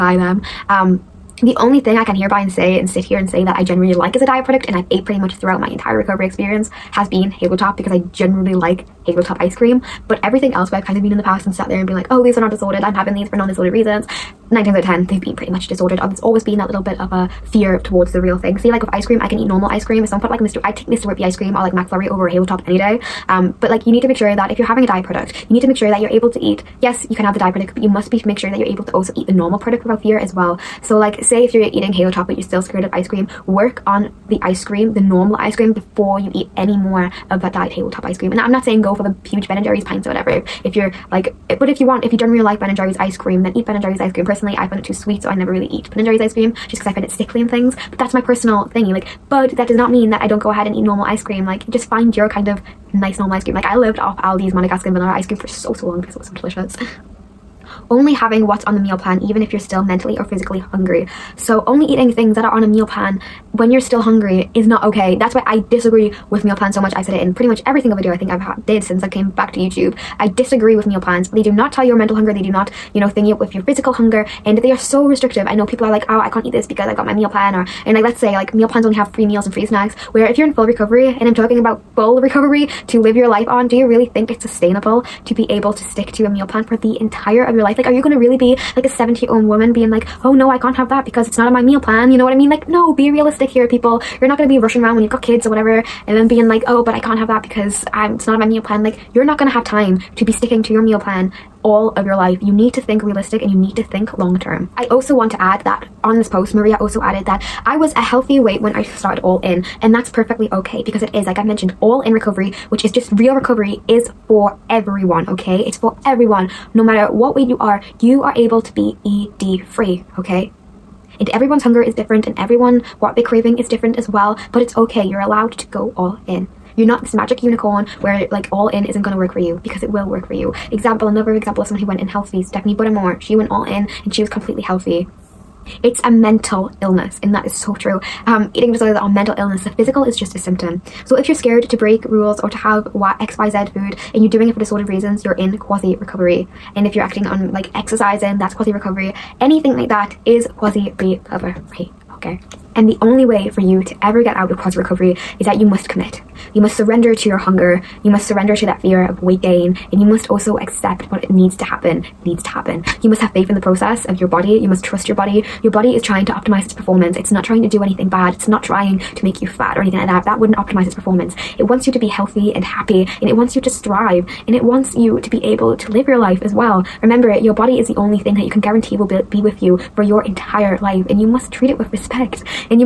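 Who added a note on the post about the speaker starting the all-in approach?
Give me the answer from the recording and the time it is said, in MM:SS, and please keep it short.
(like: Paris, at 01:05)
Maria, at 01:46.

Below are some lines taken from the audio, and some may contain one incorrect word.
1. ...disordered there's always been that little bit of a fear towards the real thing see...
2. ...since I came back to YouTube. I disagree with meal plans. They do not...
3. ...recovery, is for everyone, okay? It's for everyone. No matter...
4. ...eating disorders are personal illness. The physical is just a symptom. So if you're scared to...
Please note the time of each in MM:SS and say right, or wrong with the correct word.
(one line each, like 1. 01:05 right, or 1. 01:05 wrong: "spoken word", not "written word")
1. 00:15 right
2. 01:08 right
3. 01:53 right
4. 02:18 wrong: "mental", not "personal".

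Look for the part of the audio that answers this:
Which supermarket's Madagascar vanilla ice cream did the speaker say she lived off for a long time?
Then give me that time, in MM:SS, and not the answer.
00:54.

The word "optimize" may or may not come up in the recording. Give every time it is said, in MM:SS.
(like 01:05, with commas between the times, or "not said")
02:46, 02:50.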